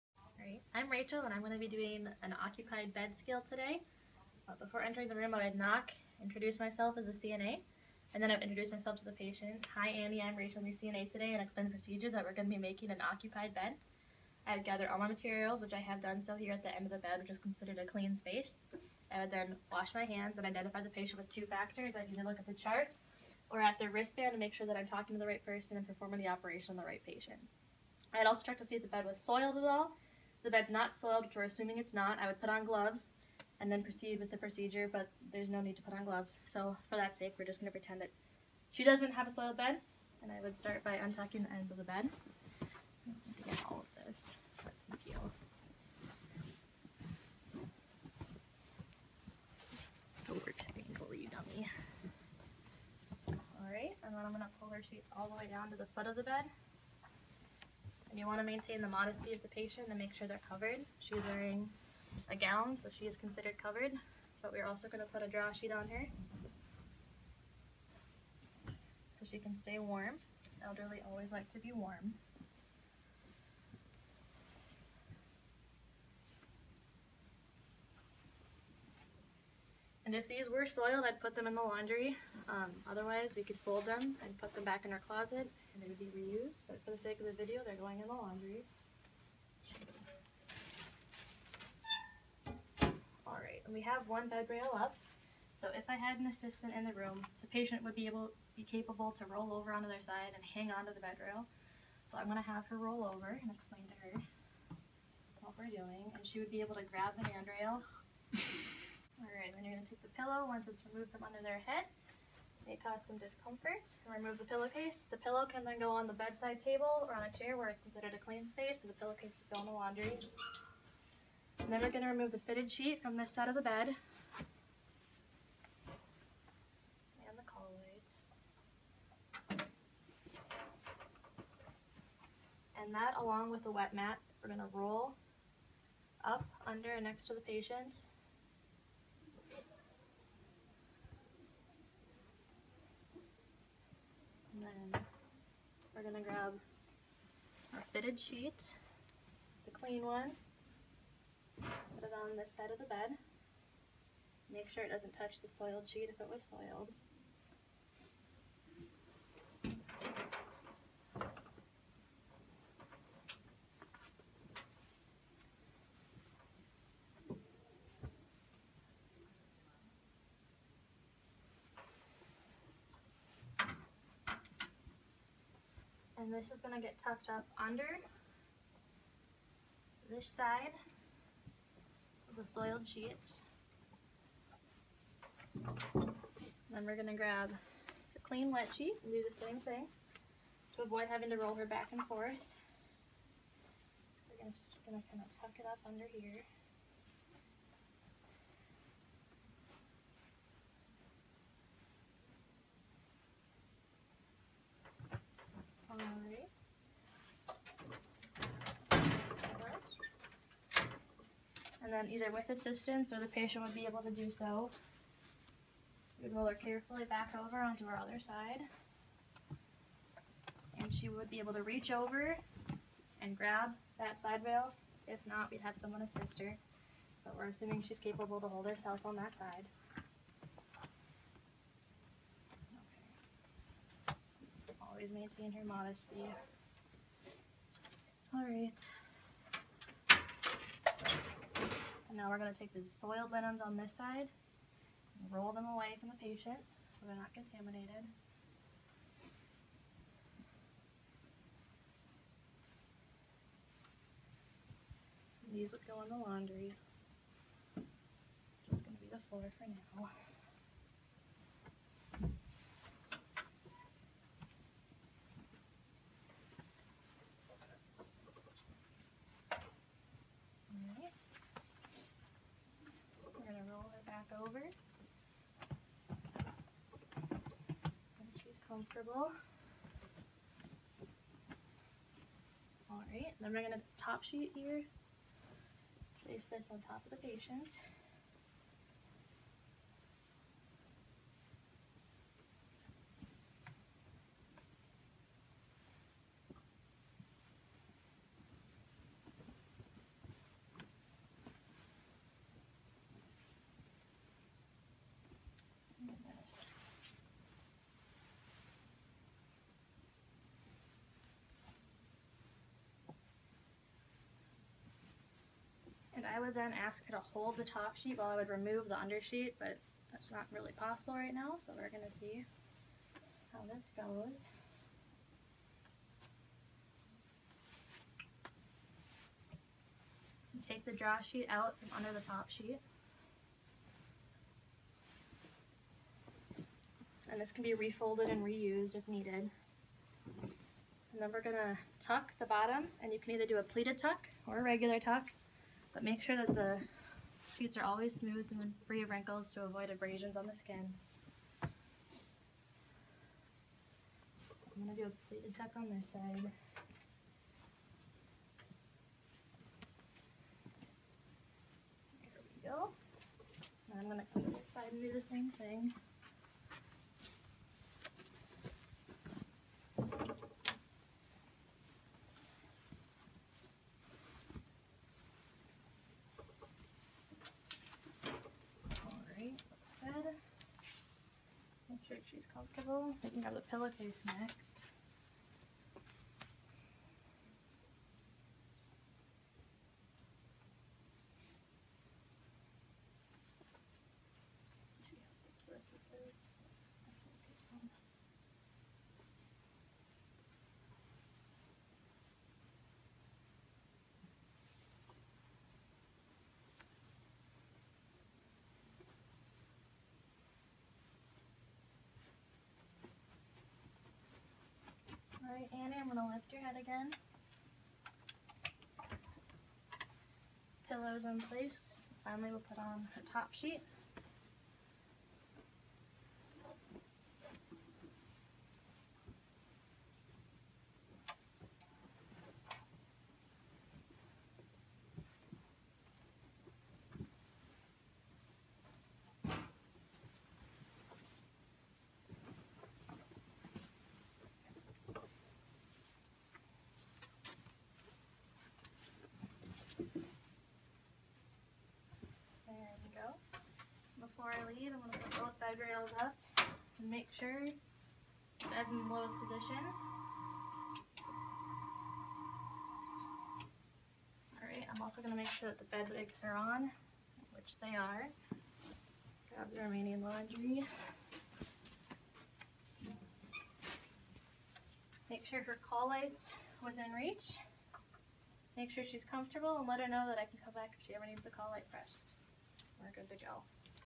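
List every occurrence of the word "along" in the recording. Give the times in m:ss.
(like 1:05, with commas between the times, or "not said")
2:13.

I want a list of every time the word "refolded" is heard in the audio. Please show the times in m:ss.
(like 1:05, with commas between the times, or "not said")
5:37.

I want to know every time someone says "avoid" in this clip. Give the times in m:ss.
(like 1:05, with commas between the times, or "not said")
3:10, 5:49.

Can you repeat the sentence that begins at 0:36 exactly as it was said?
So for that sake, we're just going to pretend that she doesn't have a soiled bed.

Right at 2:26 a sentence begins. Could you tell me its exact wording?
We're gonna grab our fitted sheet, the clean one, put it on this side of the bed.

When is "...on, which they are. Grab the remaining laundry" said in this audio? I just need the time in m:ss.
7:46.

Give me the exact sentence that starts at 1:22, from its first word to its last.
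Um, otherwise, we could fold them and put them back in our closet and they would be reused.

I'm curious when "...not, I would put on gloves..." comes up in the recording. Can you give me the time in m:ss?
0:31.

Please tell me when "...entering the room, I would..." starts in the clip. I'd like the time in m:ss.
0:04.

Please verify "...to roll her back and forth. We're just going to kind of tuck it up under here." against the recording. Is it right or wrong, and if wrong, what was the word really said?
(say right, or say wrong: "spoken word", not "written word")
right.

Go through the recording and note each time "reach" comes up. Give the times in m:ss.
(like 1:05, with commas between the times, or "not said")
3:41, 7:57.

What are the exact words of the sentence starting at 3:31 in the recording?
and then either with assistance or the patient would be able to do so.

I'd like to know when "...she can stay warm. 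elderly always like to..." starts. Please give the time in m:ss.
1:09.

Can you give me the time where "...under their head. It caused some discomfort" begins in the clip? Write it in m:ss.
1:51.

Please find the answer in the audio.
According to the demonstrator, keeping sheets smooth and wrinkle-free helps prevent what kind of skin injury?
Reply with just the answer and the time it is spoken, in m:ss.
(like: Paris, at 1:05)
Abrasions, at 5:49.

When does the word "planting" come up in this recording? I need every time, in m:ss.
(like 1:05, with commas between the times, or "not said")
not said.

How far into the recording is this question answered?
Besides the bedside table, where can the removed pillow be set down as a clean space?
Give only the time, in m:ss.
1:57.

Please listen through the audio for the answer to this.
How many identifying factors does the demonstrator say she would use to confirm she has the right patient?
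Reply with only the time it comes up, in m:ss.
0:21.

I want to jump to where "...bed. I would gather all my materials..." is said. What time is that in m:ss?
0:13.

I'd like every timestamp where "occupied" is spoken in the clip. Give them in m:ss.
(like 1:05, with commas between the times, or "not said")
0:02, 0:12.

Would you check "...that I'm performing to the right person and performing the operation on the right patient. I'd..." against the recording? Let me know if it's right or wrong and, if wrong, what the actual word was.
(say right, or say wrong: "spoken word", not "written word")
wrong: "talking", not "performing".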